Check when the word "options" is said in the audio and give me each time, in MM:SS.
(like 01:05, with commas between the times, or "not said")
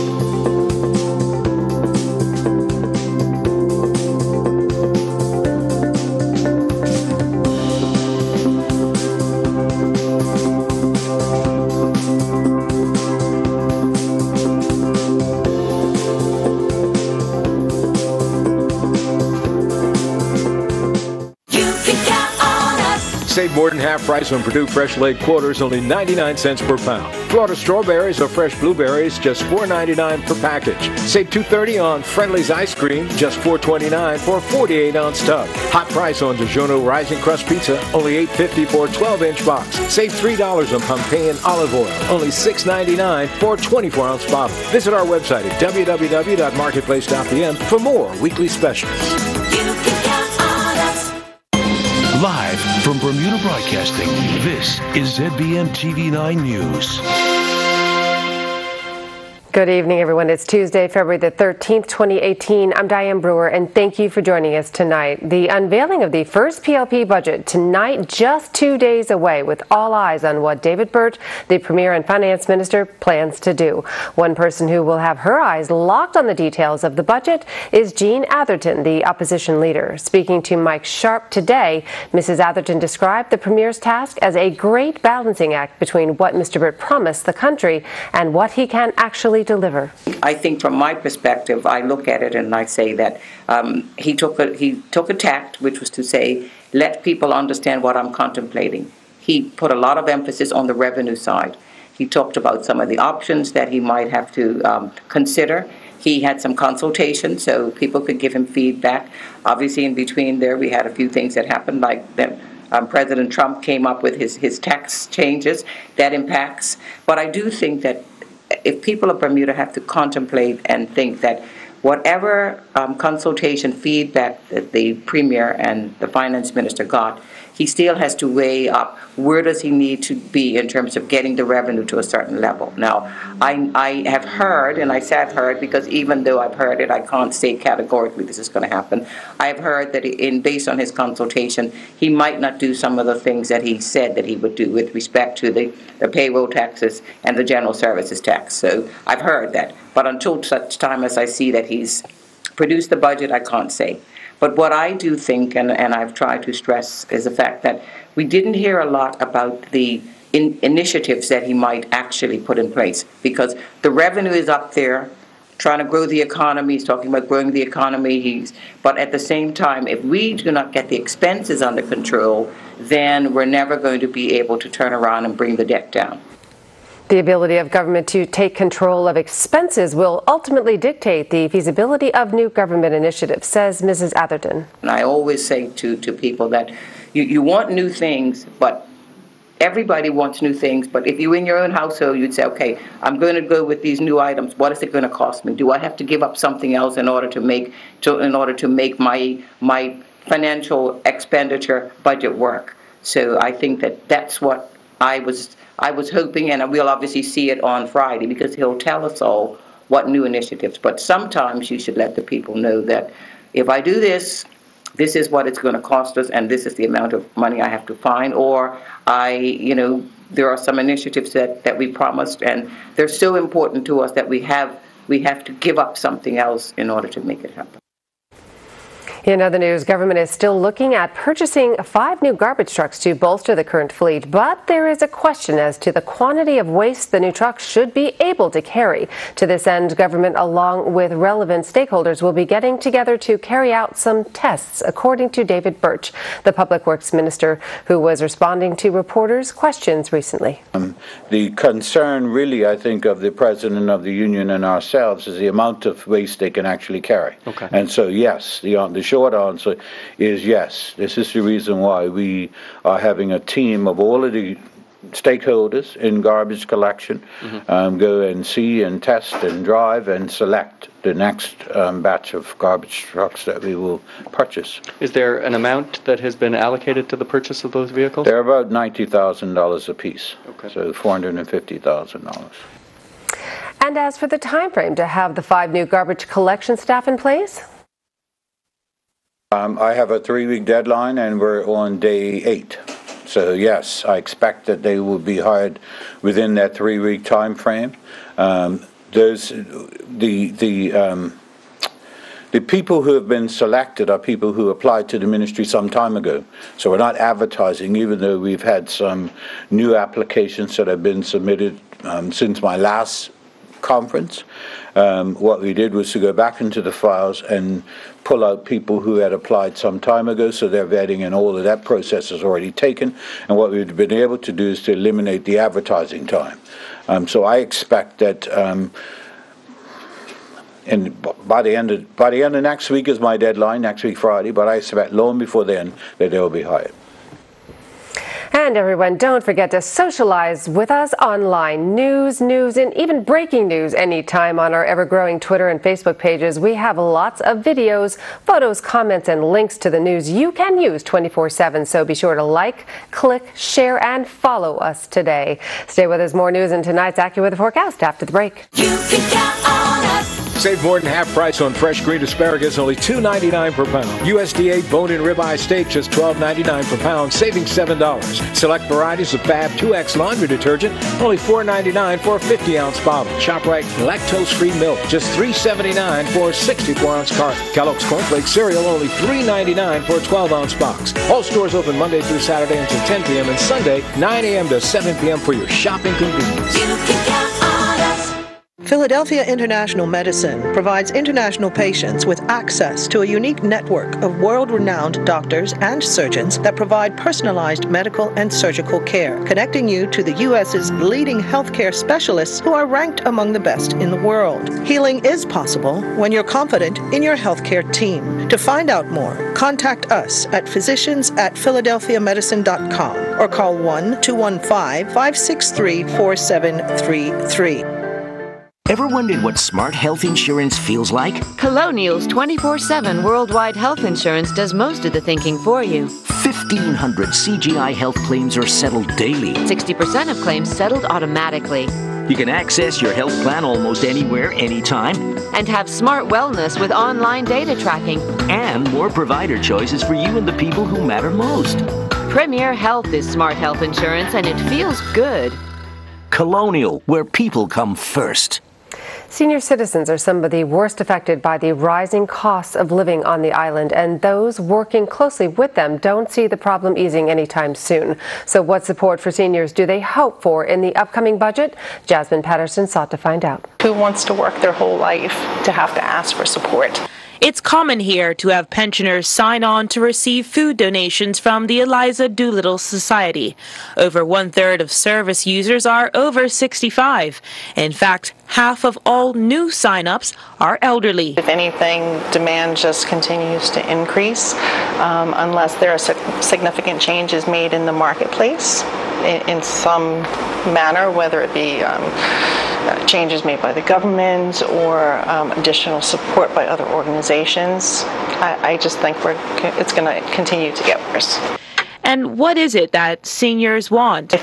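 01:42.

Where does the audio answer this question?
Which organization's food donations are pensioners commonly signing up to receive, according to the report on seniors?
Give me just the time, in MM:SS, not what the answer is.
07:51.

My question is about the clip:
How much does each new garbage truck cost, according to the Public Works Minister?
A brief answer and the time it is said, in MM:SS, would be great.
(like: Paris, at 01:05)
$90,000, at 04:38.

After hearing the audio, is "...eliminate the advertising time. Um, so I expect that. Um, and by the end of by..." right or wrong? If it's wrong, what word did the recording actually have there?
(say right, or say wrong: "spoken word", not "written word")
right.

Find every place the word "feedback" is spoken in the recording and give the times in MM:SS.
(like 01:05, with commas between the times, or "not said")
01:48, 02:03.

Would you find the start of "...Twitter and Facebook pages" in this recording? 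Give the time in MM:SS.
05:45.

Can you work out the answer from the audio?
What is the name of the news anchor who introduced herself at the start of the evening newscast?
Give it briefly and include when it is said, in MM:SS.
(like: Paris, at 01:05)
Diane Brewer, at 01:02.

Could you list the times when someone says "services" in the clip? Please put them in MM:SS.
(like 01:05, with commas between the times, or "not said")
02:27, 07:54.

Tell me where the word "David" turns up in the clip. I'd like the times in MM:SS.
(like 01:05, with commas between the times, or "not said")
01:10, 04:05.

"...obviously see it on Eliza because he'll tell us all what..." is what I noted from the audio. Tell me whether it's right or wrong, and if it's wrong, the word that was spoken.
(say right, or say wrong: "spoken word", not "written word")
wrong: "Friday", not "Eliza".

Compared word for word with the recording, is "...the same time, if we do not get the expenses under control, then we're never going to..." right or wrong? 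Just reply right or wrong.
right.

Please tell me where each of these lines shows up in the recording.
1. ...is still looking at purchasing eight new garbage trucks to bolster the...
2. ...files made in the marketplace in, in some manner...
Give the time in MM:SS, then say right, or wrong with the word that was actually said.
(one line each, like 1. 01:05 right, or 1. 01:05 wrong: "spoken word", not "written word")
1. 03:50 wrong: "five", not "eight"
2. 08:07 wrong: "changes", not "files".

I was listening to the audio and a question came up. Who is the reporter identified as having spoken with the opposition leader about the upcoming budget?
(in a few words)
Mike Sharp.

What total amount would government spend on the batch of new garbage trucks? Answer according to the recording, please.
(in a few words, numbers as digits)
$450,000.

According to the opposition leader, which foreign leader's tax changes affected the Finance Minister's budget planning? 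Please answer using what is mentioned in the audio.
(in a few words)
President Trump.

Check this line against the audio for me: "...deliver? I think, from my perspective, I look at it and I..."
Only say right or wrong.
right.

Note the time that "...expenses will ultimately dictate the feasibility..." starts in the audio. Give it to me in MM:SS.
02:59.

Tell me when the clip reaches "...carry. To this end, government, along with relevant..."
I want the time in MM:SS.
03:58.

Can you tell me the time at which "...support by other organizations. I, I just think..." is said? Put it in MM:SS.
08:16.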